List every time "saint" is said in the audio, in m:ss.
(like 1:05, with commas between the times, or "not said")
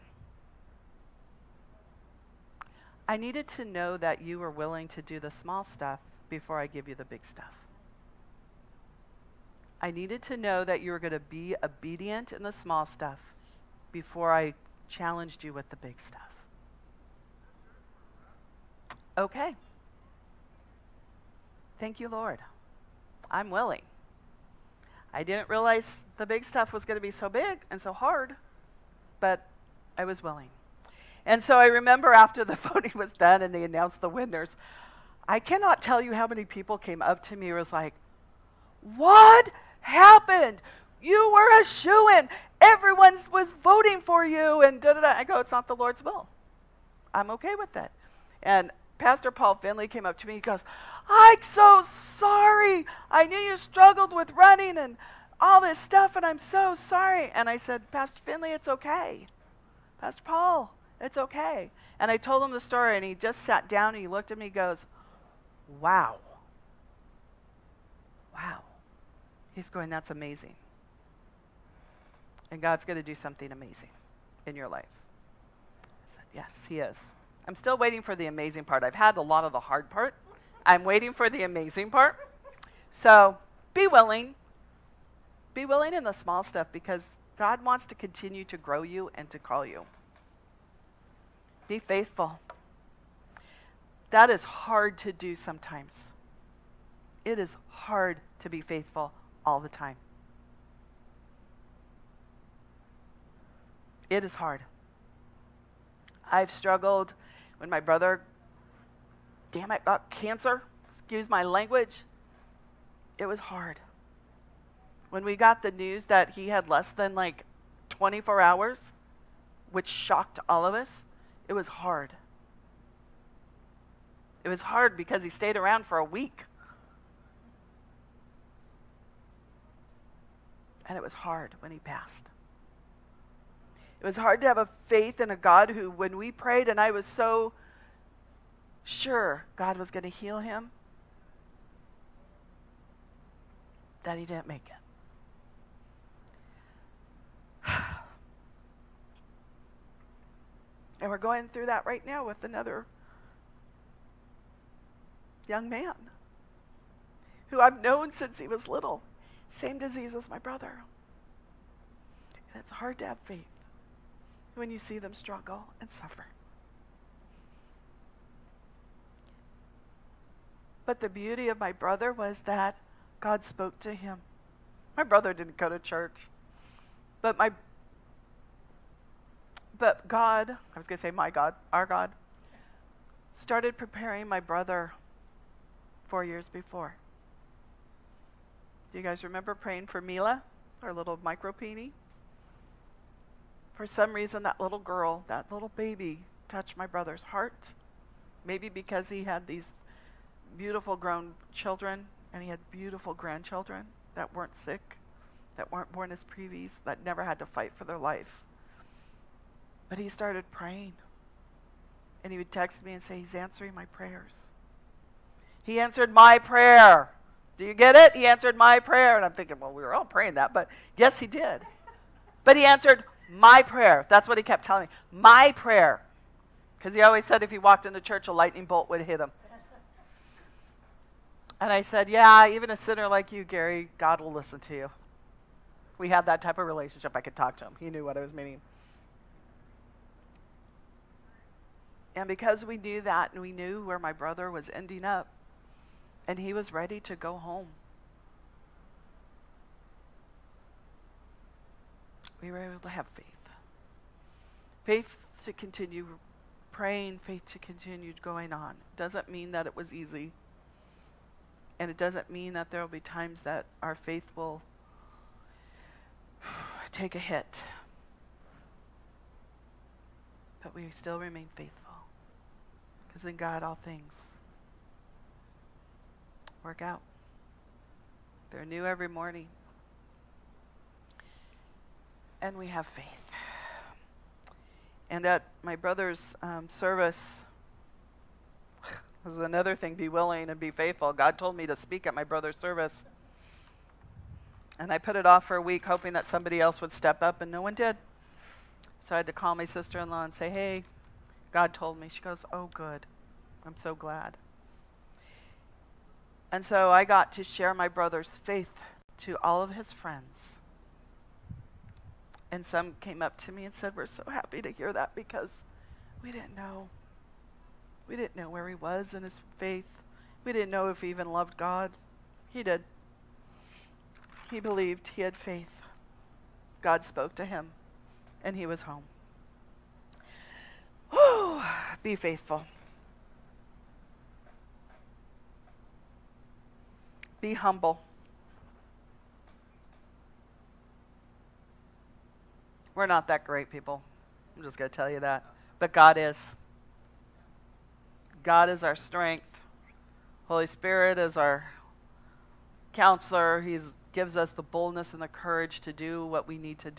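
not said.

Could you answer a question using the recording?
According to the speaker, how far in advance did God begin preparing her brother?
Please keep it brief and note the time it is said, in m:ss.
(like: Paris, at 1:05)
4 years, at 3:06.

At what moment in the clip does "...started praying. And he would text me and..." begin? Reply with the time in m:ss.
3:30.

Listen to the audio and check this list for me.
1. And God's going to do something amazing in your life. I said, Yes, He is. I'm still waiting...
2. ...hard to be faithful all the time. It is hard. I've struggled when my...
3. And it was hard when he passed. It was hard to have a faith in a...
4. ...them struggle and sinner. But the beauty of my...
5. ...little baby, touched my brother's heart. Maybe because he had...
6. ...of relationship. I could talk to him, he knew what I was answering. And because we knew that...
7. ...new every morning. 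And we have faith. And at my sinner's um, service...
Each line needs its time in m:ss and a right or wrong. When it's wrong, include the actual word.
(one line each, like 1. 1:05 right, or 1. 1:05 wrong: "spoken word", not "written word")
1. 1:12 right
2. 1:37 right
3. 2:10 right
4. 2:44 wrong: "suffer", not "sinner"
5. 3:15 right
6. 3:56 wrong: "meaning", not "answering"
7. 4:38 wrong: "brother", not "sinner".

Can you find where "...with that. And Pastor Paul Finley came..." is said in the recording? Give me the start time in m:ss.
0:47.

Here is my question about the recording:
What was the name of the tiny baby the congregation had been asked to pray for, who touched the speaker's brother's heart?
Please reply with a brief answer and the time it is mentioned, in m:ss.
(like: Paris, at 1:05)
Mila, at 3:09.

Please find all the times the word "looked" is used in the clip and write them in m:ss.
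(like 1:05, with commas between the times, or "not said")
1:04.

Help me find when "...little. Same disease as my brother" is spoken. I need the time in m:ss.
2:38.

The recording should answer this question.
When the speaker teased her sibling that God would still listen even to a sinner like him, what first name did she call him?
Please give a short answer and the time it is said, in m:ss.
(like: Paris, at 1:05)
Gary, at 3:53.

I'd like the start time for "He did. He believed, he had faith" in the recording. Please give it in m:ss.
5:22.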